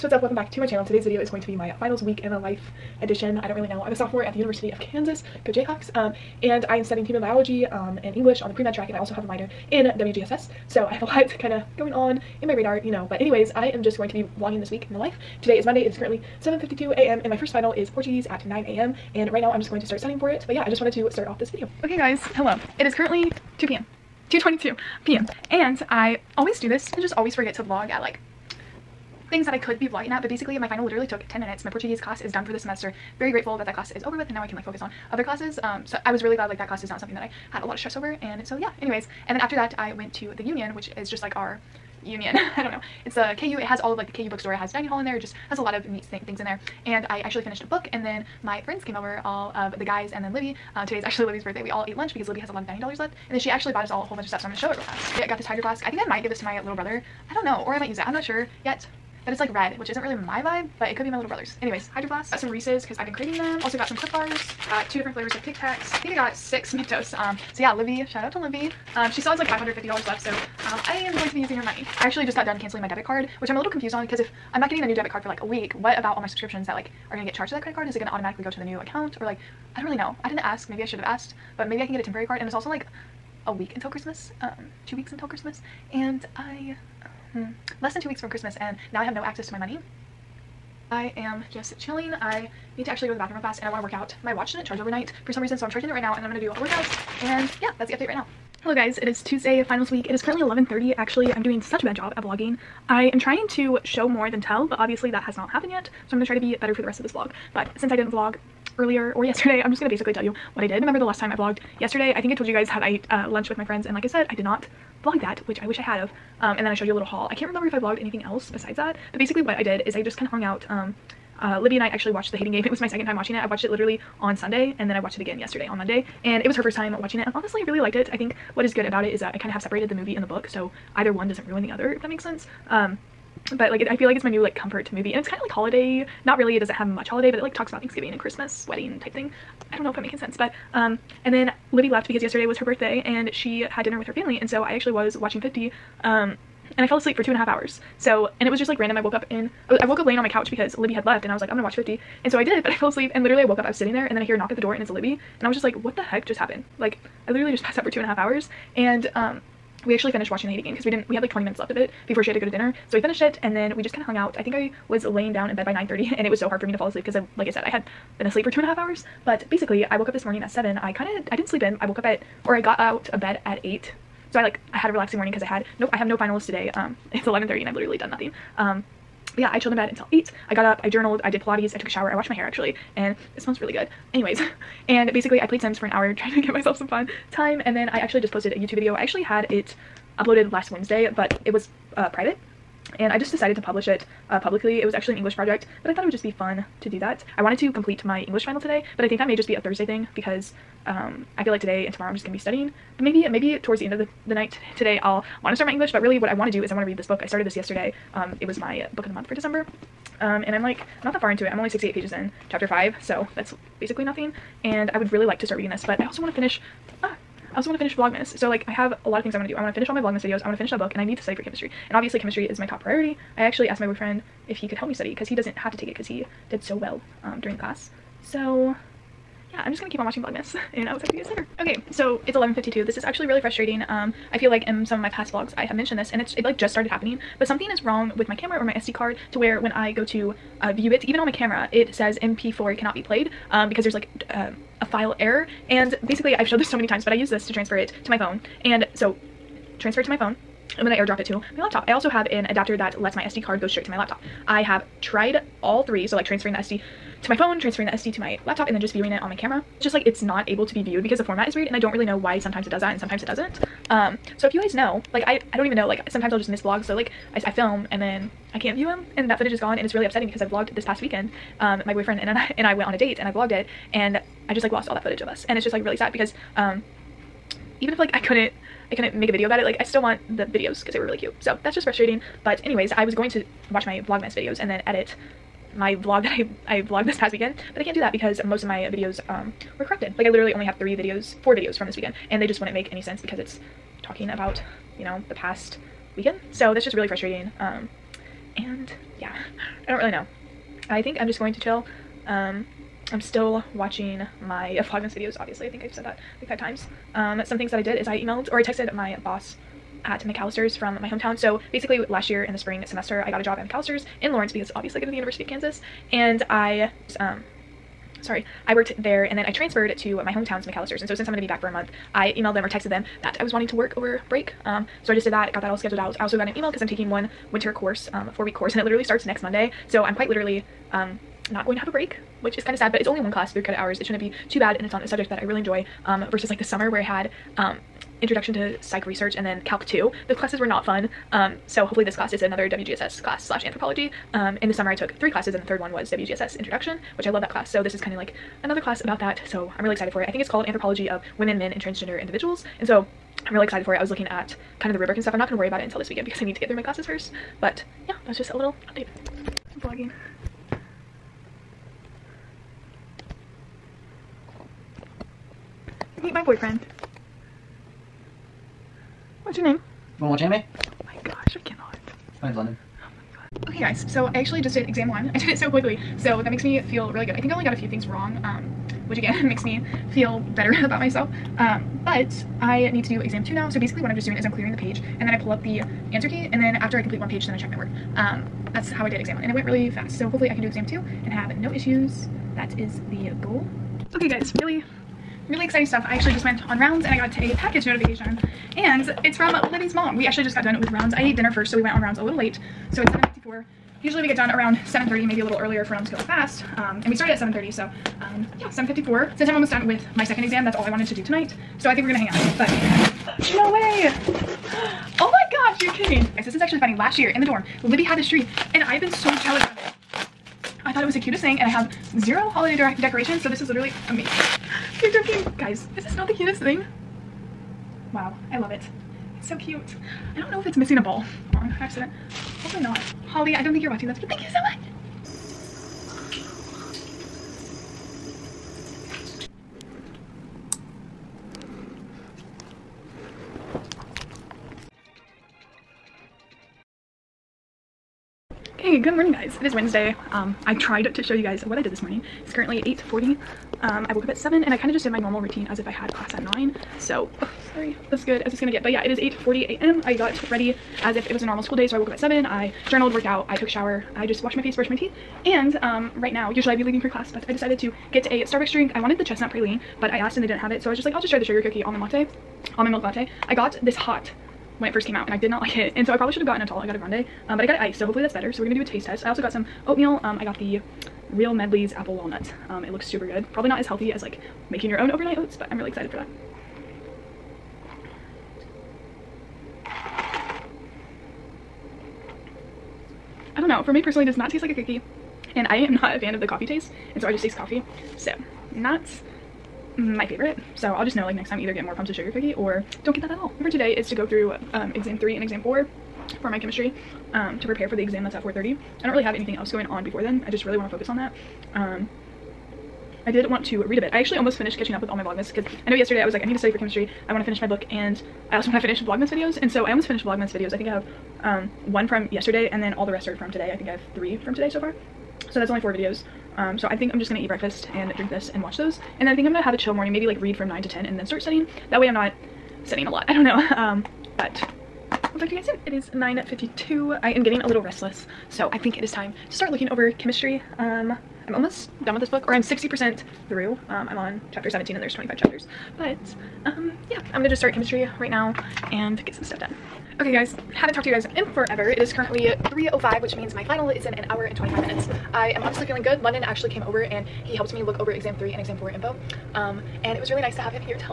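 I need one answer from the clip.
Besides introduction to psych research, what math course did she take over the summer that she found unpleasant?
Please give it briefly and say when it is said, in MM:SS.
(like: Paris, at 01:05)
Calc 2, at 05:39.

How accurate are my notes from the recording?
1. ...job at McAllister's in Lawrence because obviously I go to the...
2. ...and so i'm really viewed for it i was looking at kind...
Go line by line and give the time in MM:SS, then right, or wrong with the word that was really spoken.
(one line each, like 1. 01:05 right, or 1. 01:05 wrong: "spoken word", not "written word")
1. 05:13 right
2. 05:52 wrong: "excited", not "viewed".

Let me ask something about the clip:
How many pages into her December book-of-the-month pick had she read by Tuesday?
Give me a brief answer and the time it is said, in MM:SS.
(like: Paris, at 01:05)
68, at 03:31.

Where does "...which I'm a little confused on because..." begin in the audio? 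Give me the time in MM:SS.
01:13.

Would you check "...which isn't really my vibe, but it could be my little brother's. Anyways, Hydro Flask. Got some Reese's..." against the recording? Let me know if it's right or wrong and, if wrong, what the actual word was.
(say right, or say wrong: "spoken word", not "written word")
right.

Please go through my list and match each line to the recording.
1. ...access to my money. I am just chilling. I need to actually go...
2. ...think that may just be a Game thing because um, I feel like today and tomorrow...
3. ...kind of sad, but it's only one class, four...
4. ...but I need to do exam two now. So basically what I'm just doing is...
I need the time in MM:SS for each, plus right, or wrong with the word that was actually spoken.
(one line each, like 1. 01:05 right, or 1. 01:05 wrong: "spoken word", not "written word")
1. 01:29 right
2. 03:19 wrong: "Thursday", not "Game"
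3. 05:32 wrong: "three", not "four"
4. 06:22 right.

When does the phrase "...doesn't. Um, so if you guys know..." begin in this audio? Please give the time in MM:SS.
04:23.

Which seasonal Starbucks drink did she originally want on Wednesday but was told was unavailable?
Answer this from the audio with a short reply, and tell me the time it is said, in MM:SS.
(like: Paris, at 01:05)
Chestnut praline, at 07:49.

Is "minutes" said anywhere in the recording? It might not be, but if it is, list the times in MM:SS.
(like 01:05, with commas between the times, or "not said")
00:31, 02:41, 09:14.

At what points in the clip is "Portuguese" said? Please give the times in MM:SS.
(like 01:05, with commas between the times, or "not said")
00:17, 00:31.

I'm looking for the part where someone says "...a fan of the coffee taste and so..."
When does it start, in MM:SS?
08:16.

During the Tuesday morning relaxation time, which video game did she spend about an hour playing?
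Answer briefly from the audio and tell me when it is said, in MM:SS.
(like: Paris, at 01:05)
Sims, at 03:05.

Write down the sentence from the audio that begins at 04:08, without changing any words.
And so, transfer to my phone.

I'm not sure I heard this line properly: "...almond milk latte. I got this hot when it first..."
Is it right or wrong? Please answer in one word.
right.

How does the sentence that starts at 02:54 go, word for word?
So I like, I had a relaxing morning because I had no, I have no finals today.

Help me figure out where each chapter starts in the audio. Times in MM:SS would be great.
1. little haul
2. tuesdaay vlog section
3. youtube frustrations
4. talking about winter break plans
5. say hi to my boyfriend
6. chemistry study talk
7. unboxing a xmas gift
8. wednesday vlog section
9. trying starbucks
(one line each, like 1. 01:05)
1. 00:54
2. 01:38
3. 03:51
4. 05:08
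5. 05:59
6. 06:13
7. 06:34
8. 07:15
9. 07:48.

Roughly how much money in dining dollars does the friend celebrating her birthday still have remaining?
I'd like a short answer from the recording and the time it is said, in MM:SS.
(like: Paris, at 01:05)
$550, at 01:09.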